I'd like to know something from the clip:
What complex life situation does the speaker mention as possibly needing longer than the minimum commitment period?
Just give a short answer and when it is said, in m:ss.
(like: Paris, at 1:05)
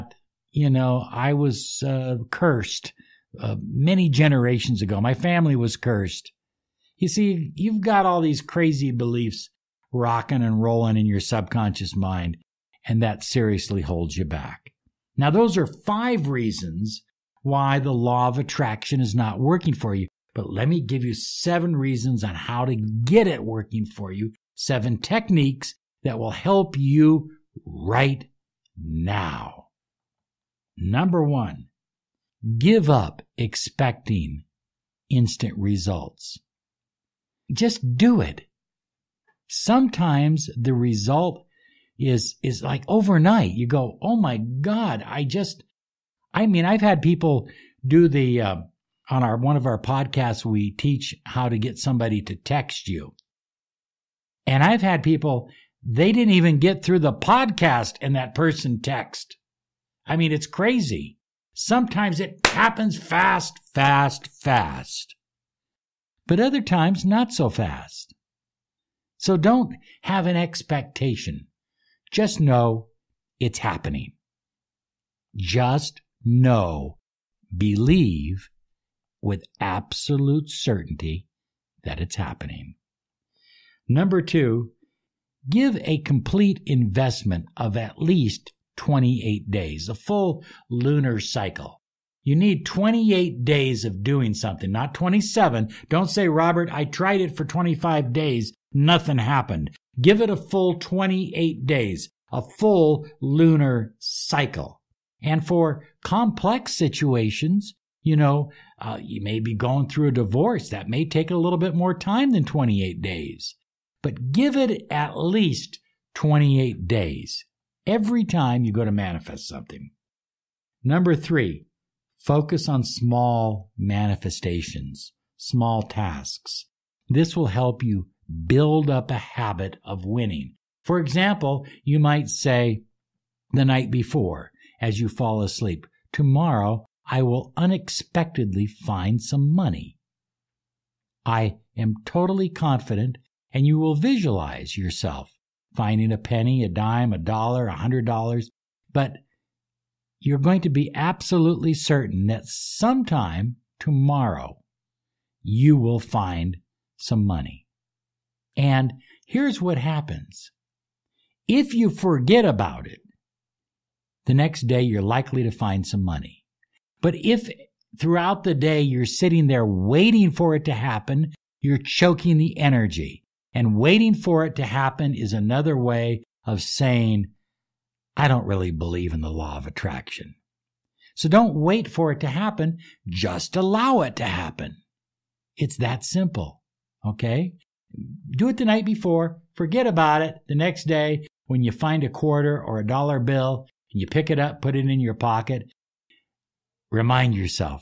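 divorce, at 1:50.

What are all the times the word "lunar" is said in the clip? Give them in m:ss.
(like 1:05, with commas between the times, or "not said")
1:30, 1:43.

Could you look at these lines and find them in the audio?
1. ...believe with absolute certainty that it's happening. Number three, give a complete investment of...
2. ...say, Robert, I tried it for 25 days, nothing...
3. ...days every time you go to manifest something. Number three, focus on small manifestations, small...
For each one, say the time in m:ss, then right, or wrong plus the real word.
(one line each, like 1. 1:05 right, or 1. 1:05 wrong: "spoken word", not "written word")
1. 1:17 wrong: "two", not "three"
2. 1:36 right
3. 1:56 right.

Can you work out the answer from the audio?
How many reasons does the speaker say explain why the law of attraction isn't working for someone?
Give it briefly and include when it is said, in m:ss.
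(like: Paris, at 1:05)
5, at 0:15.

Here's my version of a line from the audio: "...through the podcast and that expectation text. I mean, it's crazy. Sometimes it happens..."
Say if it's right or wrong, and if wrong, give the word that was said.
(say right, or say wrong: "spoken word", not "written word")
wrong: "person", not "expectation".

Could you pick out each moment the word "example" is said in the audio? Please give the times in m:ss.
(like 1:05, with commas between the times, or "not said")
2:10.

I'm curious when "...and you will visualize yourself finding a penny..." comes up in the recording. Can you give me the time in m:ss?
2:23.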